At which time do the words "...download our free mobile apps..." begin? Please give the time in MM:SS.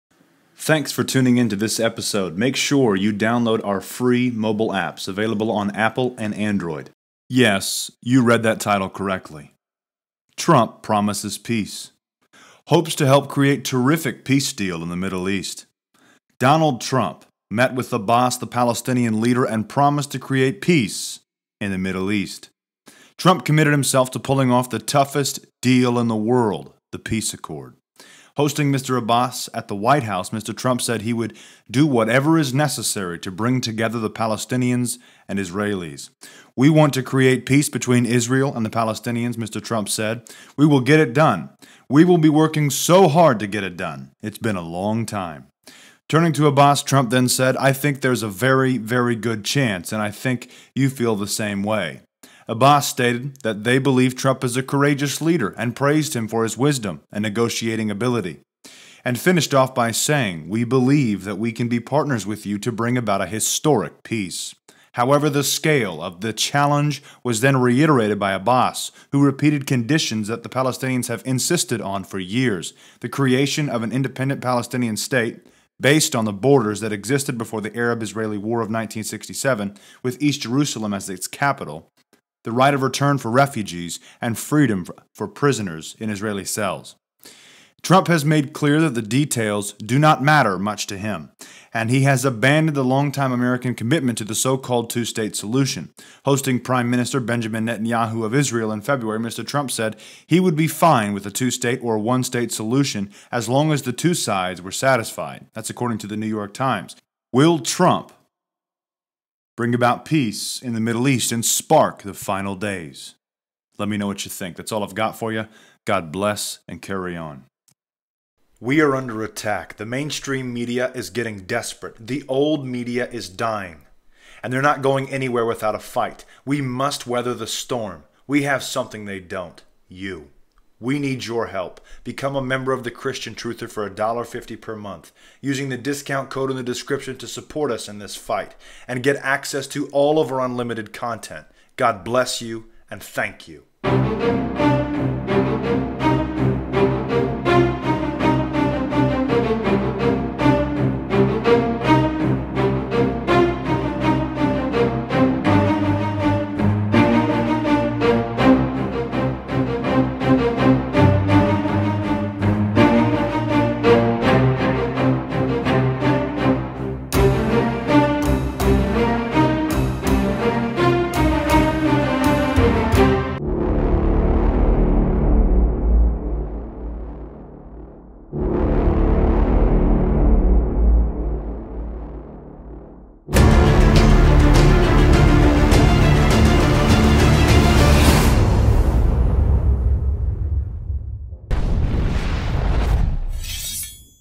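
00:03.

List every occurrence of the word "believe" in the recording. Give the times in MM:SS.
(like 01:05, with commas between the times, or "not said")
00:53, 01:00.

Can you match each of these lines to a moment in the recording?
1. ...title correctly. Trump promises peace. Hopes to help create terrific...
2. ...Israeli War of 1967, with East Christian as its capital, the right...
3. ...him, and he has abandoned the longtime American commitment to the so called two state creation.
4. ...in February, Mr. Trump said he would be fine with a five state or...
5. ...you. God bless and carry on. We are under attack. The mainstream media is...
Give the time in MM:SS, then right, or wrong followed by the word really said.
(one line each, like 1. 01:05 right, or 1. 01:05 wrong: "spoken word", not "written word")
1. 00:08 right
2. 01:18 wrong: "Jerusalem", not "Christian"
3. 01:30 wrong: "solution", not "creation"
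4. 01:38 wrong: "two", not "five"
5. 01:55 right.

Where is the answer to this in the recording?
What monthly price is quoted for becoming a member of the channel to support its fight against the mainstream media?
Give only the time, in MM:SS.
02:13.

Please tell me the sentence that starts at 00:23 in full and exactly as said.
Trump committed himself to pulling off the toughest deal in the world, the peace accord.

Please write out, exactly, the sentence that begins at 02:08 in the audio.
We have something they don't you.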